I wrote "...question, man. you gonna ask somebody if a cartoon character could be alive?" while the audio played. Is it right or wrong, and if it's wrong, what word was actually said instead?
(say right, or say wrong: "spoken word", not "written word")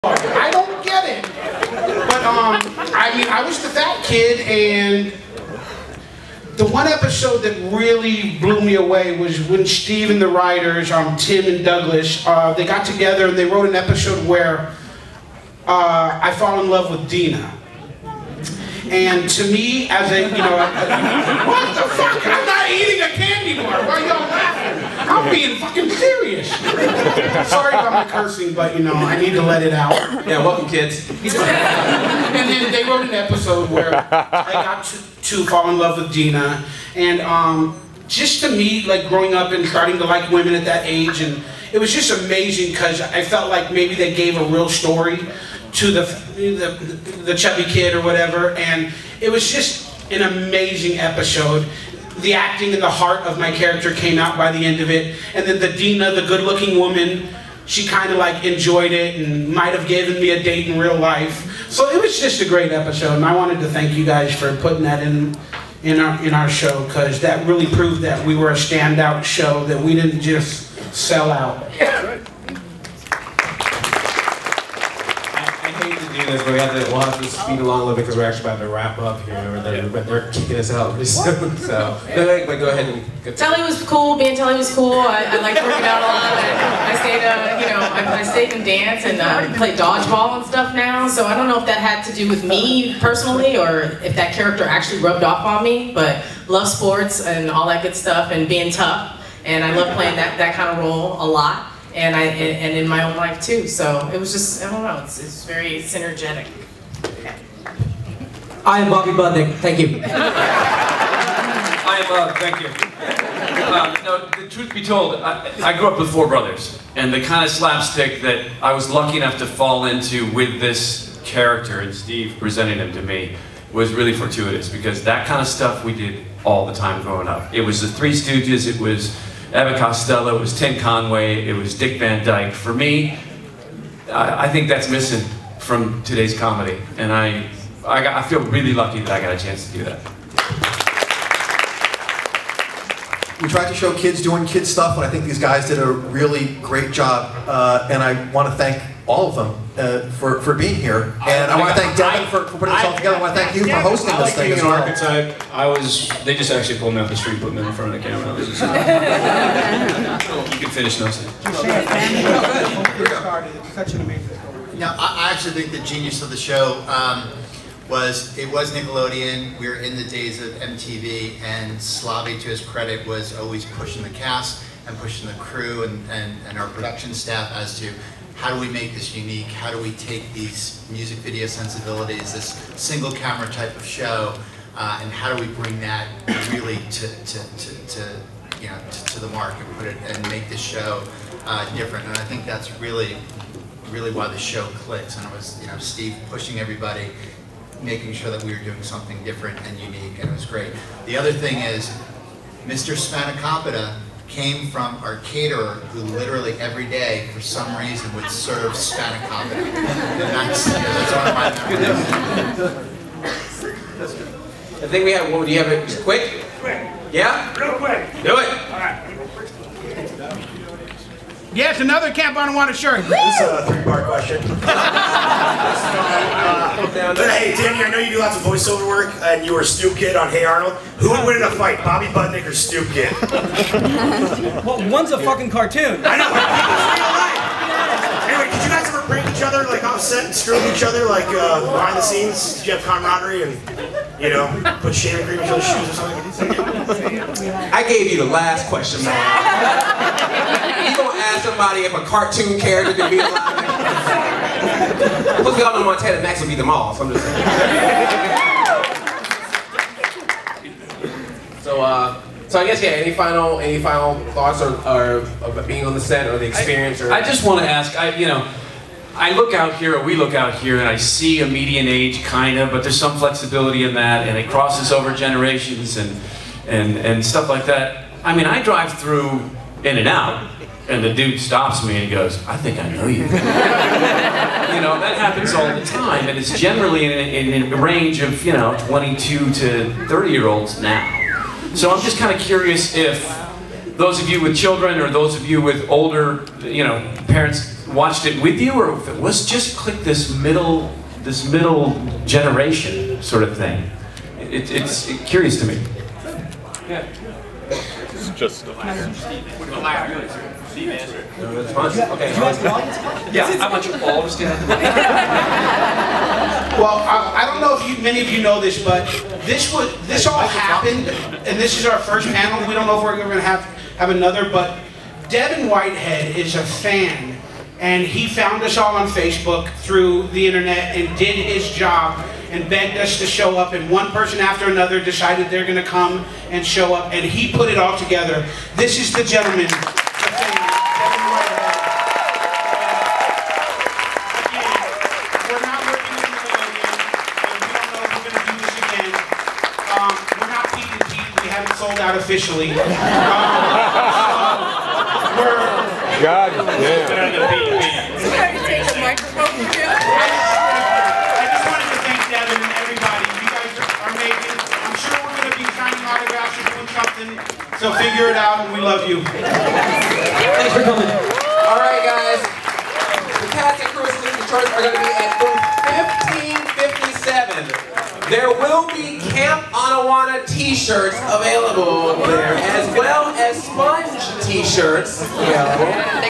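right.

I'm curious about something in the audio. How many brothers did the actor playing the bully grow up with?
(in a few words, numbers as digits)
4.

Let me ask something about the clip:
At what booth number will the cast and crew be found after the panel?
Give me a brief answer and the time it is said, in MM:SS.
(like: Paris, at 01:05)
1557, at 06:16.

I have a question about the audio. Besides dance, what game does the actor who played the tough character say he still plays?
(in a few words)
dodgeball.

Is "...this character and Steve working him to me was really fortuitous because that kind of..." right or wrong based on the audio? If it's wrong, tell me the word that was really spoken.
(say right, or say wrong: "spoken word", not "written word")
wrong: "presenting", not "working".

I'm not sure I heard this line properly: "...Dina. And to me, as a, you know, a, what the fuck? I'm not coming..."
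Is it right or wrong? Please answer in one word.
wrong.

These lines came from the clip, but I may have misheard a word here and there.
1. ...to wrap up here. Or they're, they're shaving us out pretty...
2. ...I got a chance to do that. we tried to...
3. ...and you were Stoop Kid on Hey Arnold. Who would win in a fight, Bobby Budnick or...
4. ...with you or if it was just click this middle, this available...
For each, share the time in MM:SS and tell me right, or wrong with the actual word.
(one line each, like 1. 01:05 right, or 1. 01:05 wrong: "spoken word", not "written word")
1. 01:18 wrong: "kicking", not "shaving"
2. 02:19 right
3. 03:49 right
4. 04:58 wrong: "middle", not "available".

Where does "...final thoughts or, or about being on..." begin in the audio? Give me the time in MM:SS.
04:23.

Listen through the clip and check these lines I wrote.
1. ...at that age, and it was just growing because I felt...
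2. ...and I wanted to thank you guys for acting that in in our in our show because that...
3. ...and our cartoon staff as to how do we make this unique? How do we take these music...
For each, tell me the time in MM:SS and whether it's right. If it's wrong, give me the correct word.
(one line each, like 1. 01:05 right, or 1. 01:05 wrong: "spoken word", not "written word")
1. 00:40 wrong: "amazing", not "growing"
2. 01:03 wrong: "putting", not "acting"
3. 02:56 wrong: "production", not "cartoon".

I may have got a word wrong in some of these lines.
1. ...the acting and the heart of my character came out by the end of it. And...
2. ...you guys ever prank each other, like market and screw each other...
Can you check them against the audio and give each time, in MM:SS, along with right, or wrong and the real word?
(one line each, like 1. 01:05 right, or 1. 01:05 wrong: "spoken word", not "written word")
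1. 00:52 right
2. 03:58 wrong: "offset", not "market".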